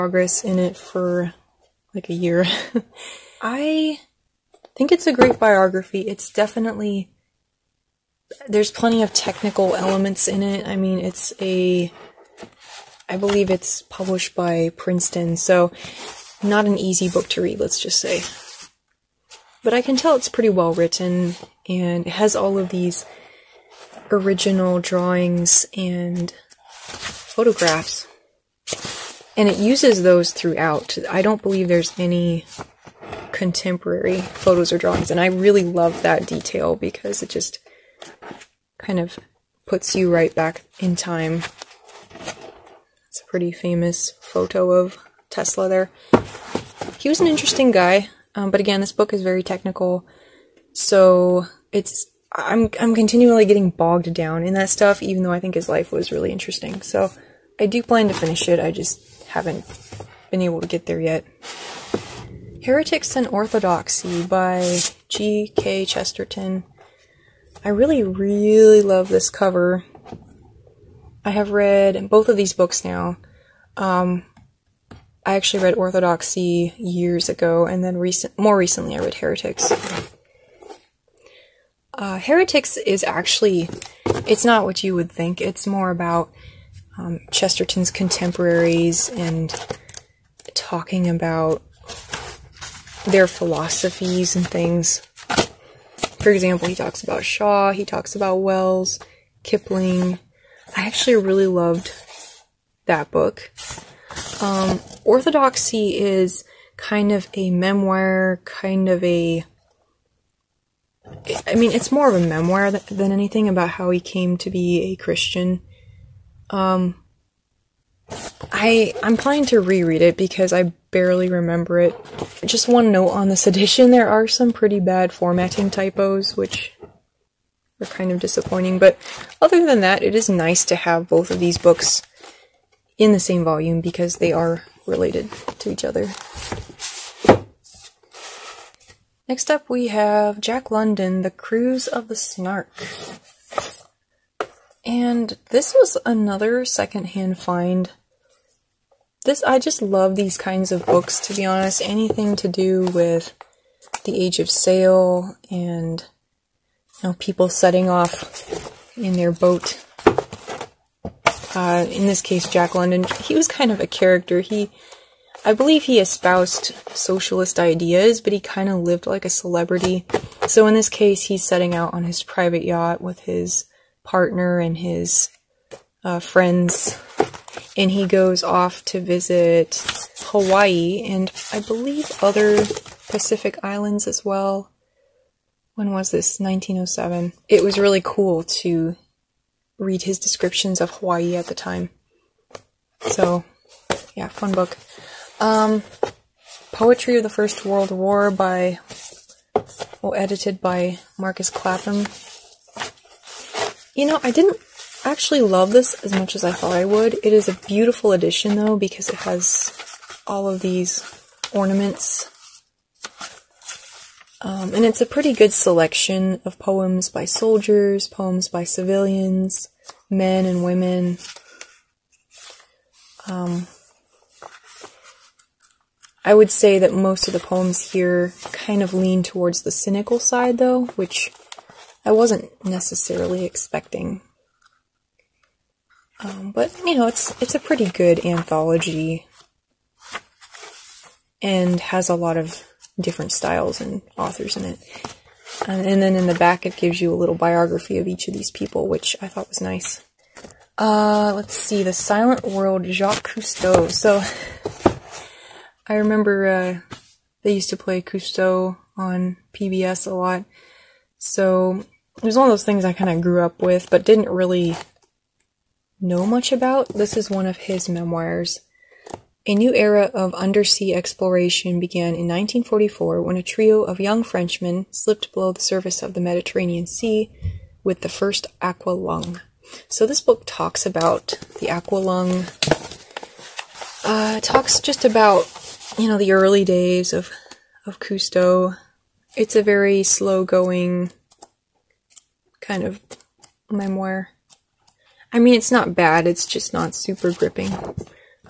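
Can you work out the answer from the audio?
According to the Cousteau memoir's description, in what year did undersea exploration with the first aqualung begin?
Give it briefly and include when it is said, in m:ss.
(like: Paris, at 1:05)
1944, at 4:32.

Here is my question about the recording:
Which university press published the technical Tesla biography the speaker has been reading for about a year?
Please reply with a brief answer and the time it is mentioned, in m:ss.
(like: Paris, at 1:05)
Princeton, at 0:14.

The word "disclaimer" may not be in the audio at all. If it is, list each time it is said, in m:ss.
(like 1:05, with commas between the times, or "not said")
not said.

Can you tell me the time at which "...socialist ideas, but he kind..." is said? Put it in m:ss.
2:46.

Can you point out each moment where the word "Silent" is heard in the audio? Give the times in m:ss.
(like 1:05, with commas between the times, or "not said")
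4:11.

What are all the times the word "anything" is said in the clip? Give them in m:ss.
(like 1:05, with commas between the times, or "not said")
1:53, 2:31.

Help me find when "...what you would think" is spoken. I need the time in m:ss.
1:24.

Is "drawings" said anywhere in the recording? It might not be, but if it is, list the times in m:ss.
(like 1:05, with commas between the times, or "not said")
0:24, 0:34.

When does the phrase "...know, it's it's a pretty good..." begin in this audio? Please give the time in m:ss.
3:56.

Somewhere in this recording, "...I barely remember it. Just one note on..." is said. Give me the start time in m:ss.
2:00.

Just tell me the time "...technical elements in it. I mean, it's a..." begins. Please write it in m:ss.
0:09.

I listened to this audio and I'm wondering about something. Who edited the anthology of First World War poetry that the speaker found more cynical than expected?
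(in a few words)
Marcus Clapham.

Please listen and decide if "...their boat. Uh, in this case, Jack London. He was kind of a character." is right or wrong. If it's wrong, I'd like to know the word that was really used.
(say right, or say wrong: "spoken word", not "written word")
right.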